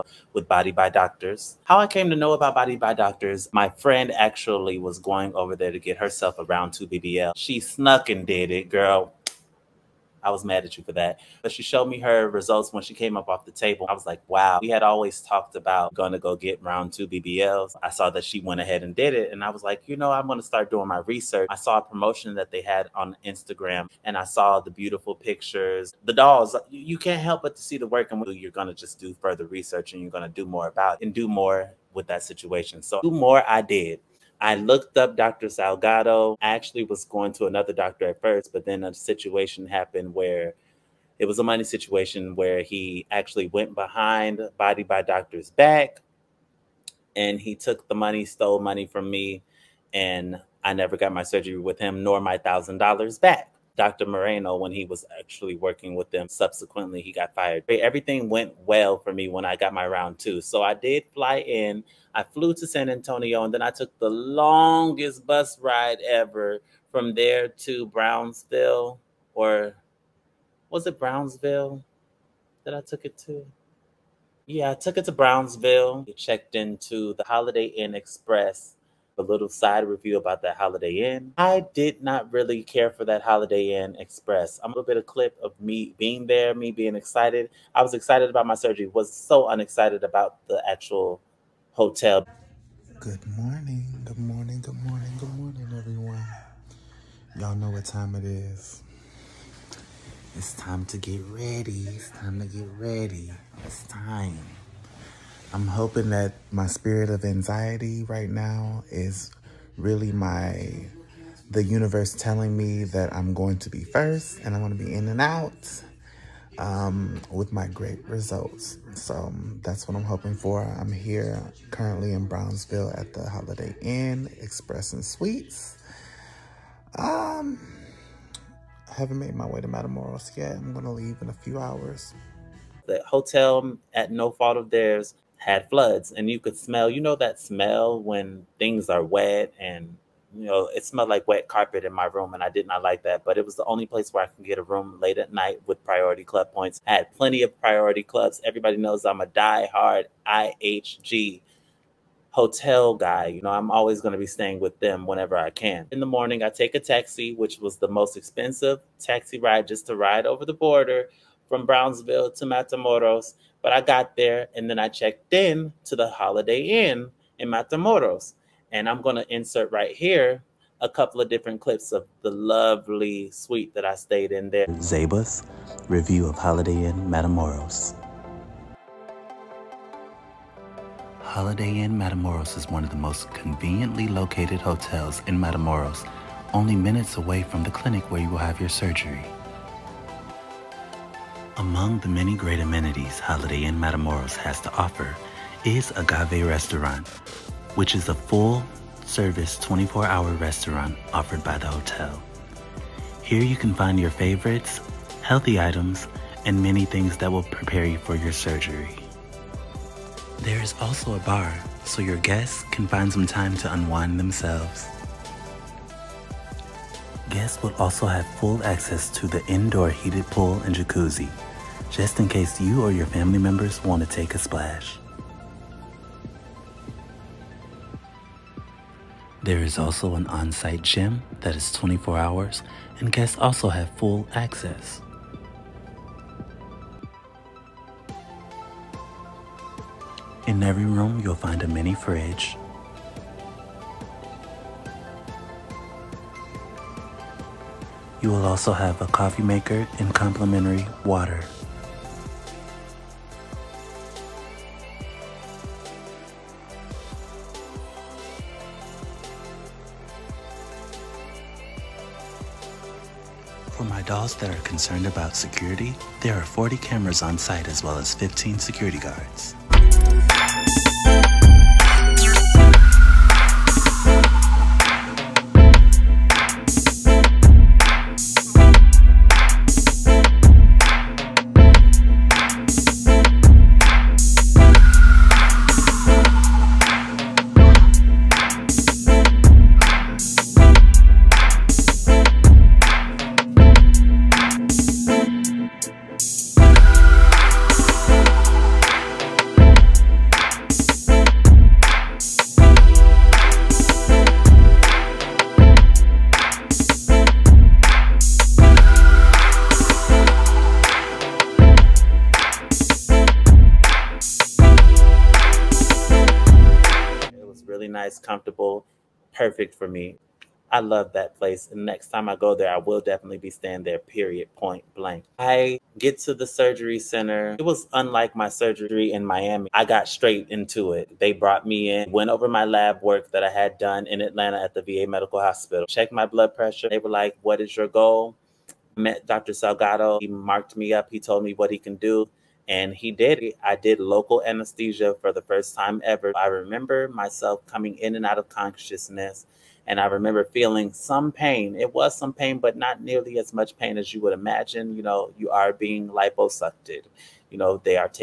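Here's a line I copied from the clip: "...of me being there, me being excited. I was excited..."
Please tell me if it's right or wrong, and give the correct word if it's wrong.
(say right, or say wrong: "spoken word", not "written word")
right.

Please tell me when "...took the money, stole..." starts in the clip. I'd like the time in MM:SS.
00:47.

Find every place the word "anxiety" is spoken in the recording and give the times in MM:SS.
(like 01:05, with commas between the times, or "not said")
01:47.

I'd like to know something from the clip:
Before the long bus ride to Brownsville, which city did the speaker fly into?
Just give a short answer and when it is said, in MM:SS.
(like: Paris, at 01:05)
San Antonio, at 01:02.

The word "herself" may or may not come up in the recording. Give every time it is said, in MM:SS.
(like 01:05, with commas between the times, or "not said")
00:05.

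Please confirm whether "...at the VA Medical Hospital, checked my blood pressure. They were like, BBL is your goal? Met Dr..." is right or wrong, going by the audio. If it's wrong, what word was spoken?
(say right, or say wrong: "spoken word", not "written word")
wrong: "What", not "BBL".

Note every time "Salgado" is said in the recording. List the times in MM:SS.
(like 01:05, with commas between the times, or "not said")
00:35, 05:39.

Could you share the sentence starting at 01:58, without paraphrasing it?
So um, that's what I'm hoping for.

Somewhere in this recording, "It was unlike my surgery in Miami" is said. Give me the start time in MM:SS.
05:27.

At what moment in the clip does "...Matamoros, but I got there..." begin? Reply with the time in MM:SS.
02:42.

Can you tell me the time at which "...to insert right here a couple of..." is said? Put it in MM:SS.
02:49.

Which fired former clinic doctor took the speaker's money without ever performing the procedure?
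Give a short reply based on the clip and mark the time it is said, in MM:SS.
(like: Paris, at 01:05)
Dr. Moreno, at 00:53.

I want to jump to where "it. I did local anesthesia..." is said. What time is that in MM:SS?
05:43.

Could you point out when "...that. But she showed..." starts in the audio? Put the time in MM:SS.
00:10.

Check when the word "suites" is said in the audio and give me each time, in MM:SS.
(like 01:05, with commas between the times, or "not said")
02:05, 02:53.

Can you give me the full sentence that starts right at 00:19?
And I was like, you know, I'm going to start doing my research.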